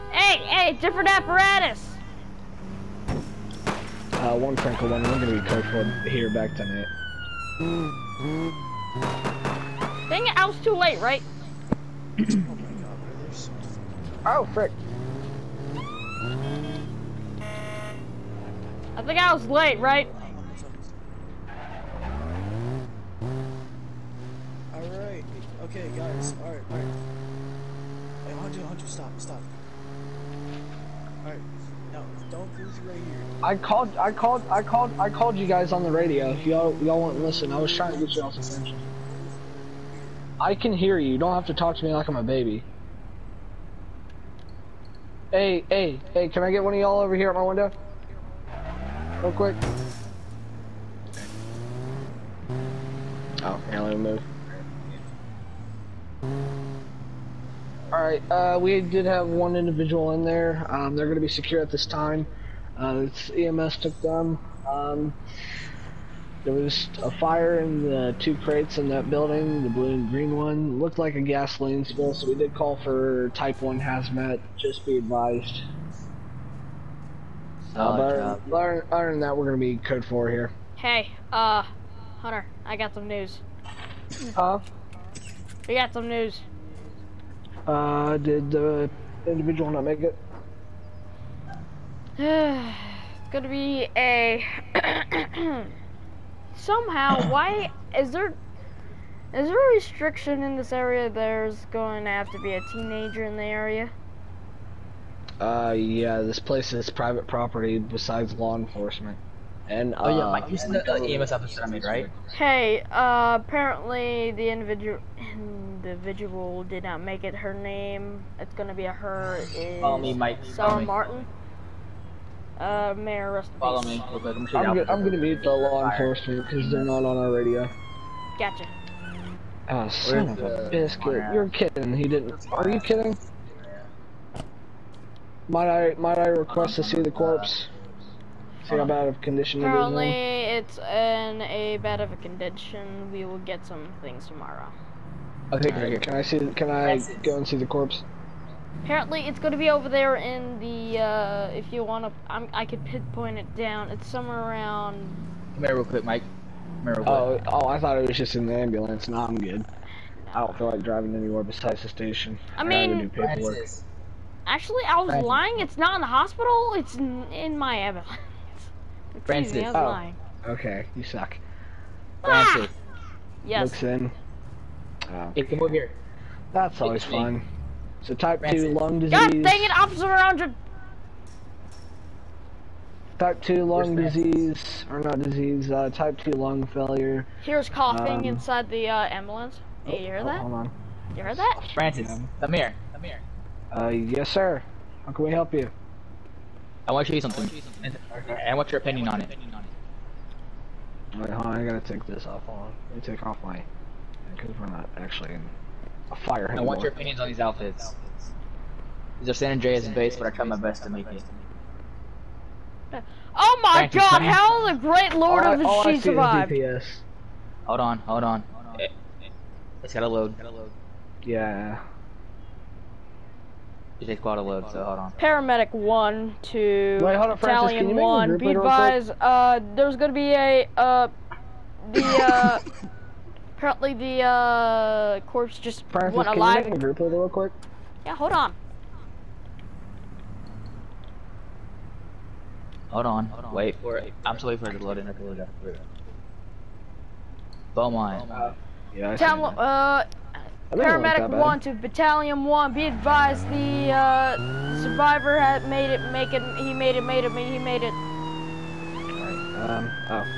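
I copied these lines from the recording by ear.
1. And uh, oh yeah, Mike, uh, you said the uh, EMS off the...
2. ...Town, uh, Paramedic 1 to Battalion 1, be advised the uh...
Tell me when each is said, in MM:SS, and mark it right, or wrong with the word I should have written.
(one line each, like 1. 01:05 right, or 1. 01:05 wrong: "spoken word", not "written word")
1. 01:49 right
2. 04:09 right.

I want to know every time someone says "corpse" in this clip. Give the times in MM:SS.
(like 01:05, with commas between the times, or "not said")
02:17, 02:27, 03:55.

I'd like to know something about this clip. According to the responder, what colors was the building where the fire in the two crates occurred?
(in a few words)
Blue and green.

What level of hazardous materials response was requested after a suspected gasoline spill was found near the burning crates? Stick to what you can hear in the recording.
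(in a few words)
Type 1 hazmat.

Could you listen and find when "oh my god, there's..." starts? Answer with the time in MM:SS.
00:12.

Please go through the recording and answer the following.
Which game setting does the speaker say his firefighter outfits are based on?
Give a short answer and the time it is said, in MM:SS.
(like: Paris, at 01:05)
San Andreas, at 03:29.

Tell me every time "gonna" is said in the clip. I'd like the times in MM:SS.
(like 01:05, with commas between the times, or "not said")
00:05, 01:33, 01:58, 02:05, 03:49.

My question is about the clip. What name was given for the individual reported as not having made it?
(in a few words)
Sarah Martin.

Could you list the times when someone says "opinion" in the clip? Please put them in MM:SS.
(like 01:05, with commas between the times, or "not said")
03:18, 03:26.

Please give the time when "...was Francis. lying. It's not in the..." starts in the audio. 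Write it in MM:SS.
02:45.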